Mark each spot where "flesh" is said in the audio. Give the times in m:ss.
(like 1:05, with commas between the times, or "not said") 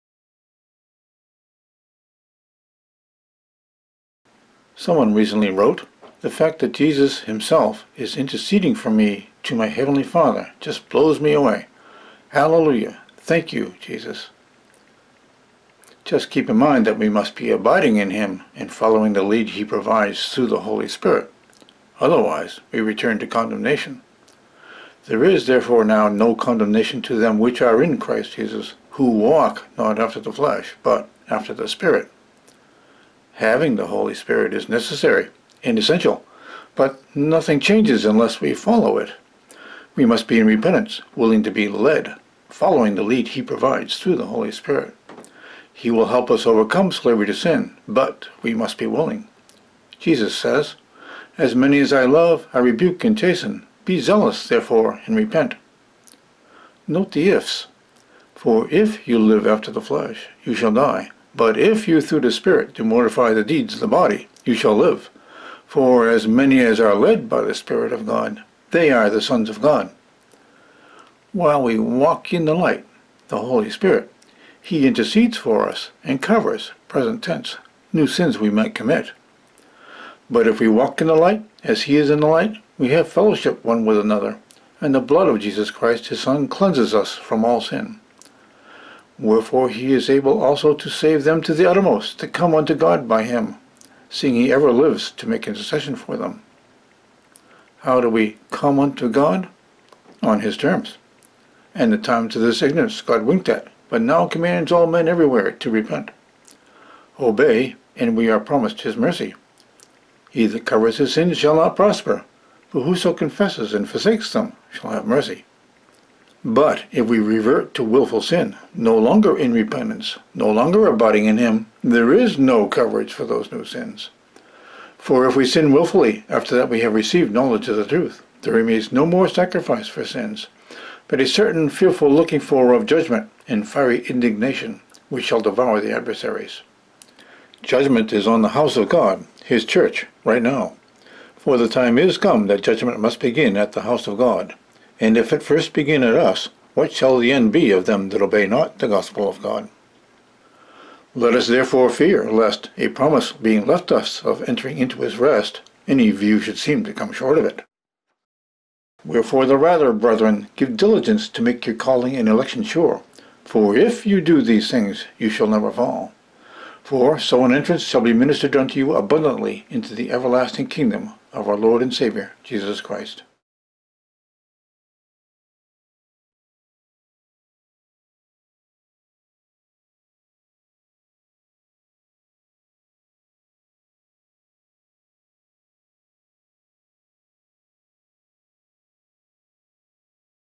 0:30, 0:59.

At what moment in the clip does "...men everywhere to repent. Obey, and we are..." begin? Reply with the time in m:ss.
1:44.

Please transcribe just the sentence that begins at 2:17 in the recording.
Judgment is on the house of God, his church, right now.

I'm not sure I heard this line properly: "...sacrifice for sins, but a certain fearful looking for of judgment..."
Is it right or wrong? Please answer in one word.
right.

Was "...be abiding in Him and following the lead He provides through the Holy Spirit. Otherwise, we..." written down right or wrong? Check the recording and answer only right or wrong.
right.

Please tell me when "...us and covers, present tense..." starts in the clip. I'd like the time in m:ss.
1:15.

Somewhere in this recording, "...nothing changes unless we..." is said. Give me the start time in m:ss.
0:37.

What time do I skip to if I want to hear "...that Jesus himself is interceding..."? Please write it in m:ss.
0:06.